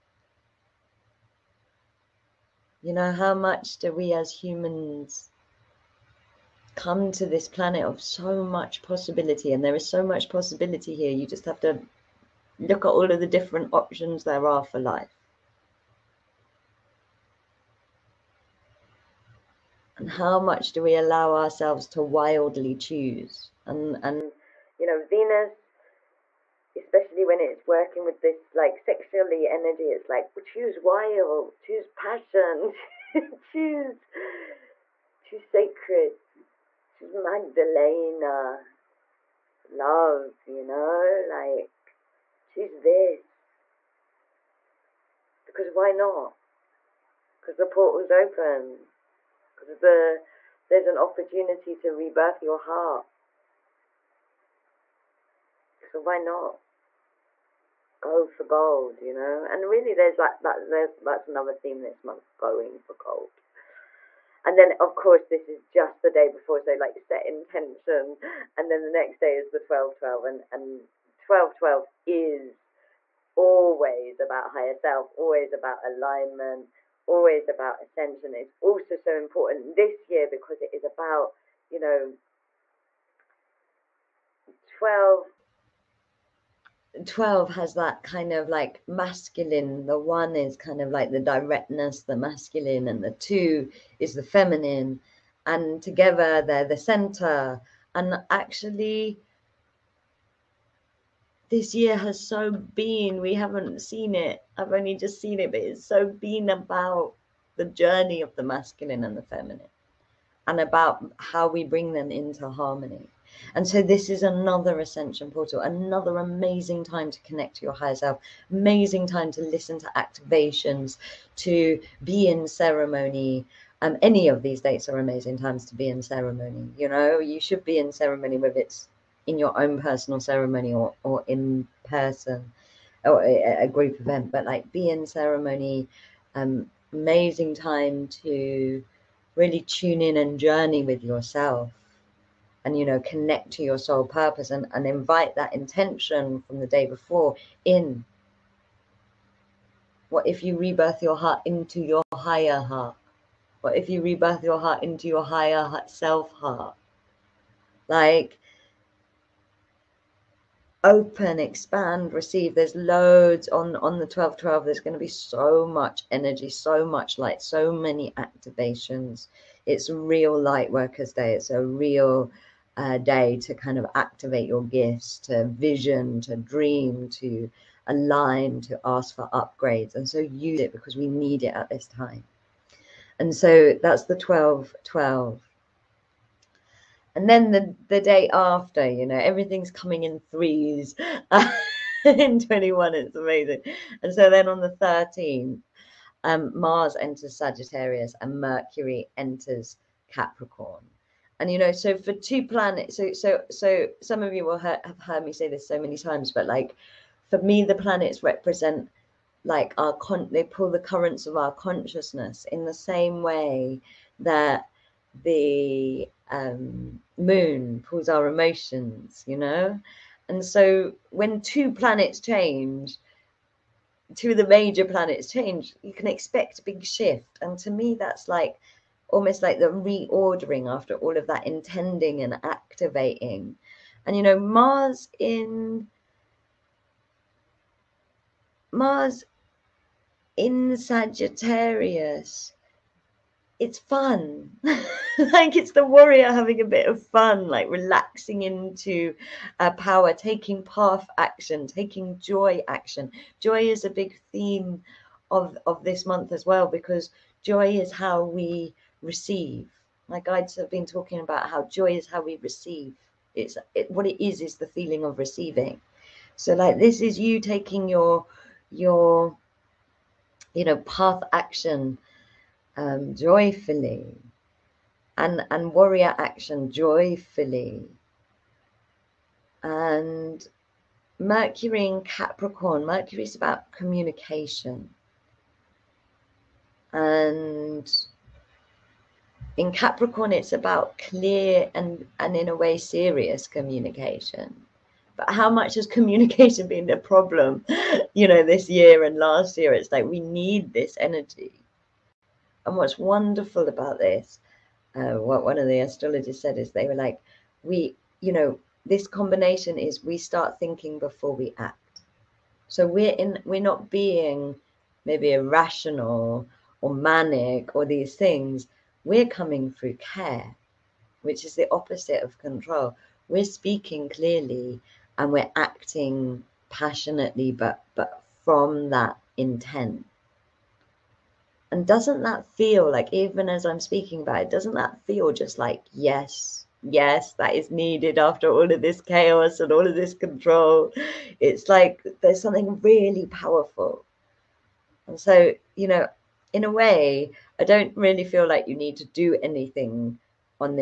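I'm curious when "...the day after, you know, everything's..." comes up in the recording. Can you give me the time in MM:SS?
03:07.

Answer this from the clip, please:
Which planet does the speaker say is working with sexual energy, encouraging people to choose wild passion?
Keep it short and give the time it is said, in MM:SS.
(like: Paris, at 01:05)
Venus, at 00:25.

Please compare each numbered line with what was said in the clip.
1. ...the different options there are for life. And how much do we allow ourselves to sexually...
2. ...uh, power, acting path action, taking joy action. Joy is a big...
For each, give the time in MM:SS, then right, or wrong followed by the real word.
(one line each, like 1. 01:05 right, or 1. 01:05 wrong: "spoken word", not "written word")
1. 00:13 wrong: "wildly", not "sexually"
2. 04:09 wrong: "taking", not "acting".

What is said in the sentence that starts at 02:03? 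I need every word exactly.
Um, any of these dates are amazing times to be in ceremony.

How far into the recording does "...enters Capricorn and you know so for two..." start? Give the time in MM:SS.
03:19.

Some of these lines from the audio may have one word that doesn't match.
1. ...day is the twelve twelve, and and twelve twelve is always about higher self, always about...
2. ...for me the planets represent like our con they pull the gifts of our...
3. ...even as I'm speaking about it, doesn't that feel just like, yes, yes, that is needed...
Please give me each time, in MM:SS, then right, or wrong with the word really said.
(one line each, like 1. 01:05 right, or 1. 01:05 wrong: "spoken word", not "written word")
1. 01:09 right
2. 03:27 wrong: "currents", not "gifts"
3. 05:33 right.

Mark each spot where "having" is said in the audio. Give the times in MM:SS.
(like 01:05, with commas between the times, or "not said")
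04:06.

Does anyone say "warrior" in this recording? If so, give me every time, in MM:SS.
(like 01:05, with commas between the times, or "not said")
04:05, 04:35.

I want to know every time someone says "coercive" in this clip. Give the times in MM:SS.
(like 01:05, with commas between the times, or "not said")
not said.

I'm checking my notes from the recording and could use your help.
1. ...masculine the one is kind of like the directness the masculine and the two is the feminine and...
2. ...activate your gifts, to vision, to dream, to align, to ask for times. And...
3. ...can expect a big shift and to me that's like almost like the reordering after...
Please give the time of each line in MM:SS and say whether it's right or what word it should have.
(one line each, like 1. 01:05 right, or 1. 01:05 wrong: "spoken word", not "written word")
1. 01:28 right
2. 02:53 wrong: "upgrades", not "times"
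3. 03:45 right.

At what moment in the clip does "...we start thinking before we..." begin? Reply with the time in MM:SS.
05:10.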